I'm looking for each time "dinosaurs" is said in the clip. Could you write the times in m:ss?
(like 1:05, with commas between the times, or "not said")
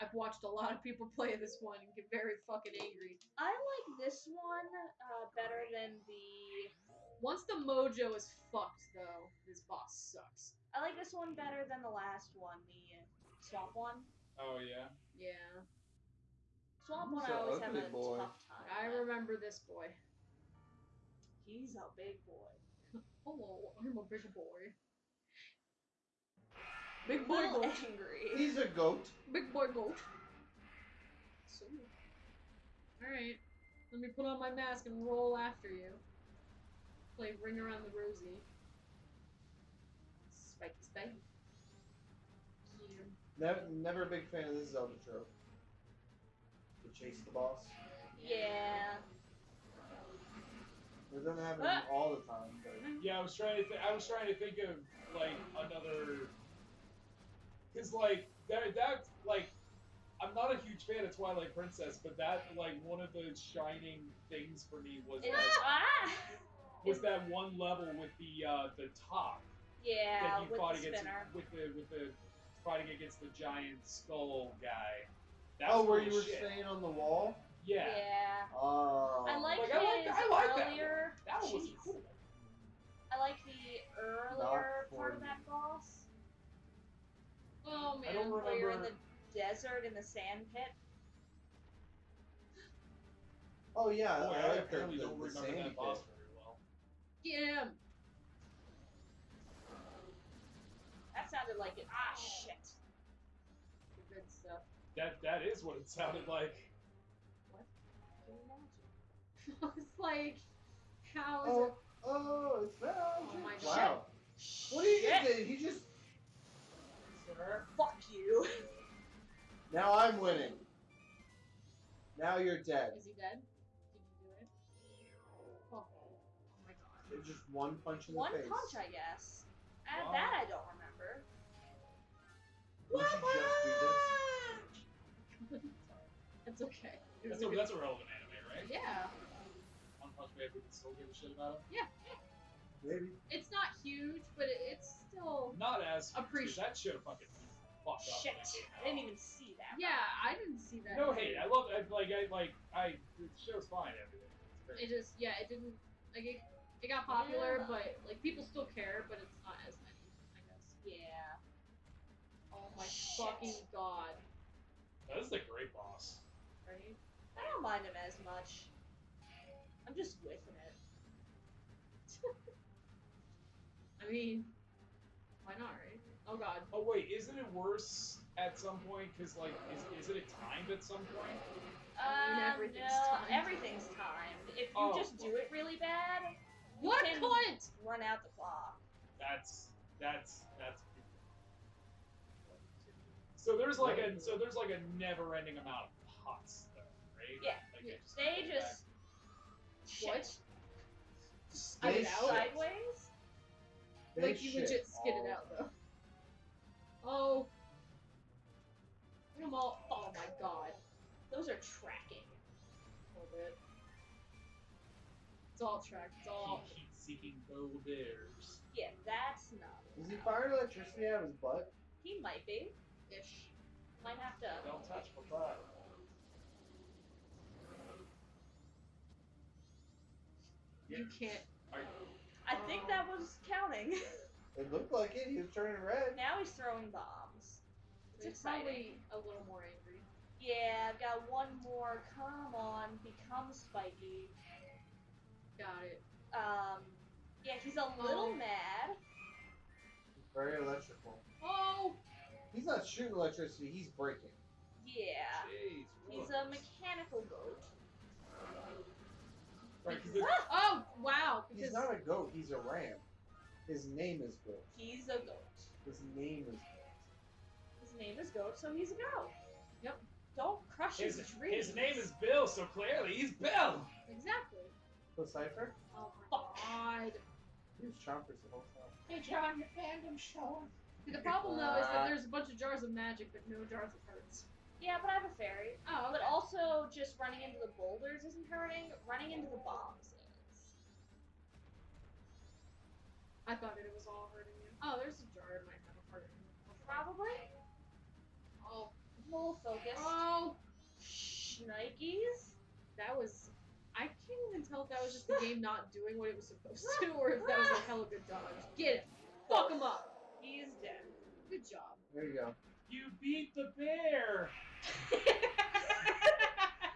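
not said.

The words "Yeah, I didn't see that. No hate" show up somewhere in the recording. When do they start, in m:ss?
2:29.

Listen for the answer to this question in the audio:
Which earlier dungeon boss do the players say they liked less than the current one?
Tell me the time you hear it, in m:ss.
0:12.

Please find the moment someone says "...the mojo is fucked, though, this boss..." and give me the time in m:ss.
0:07.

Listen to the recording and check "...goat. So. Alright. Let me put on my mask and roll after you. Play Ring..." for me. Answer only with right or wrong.
right.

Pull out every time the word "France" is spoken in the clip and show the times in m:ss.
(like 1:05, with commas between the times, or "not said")
not said.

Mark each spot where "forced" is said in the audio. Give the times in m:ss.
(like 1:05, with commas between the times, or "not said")
not said.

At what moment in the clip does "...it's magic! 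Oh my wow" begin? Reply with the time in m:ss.
1:52.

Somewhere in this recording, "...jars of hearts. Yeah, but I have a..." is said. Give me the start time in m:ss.
4:43.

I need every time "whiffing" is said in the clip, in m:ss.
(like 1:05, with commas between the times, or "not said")
2:50.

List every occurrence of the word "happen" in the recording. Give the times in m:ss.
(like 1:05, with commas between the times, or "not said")
0:51.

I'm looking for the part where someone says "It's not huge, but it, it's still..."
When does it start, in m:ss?
2:23.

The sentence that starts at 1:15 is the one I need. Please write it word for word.
That oh, where you were staying on the wall?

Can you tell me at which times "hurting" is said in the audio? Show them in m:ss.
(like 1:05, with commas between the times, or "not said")
4:48, 4:54.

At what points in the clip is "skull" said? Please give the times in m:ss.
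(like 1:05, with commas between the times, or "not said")
1:13.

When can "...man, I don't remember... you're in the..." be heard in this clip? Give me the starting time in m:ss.
1:27.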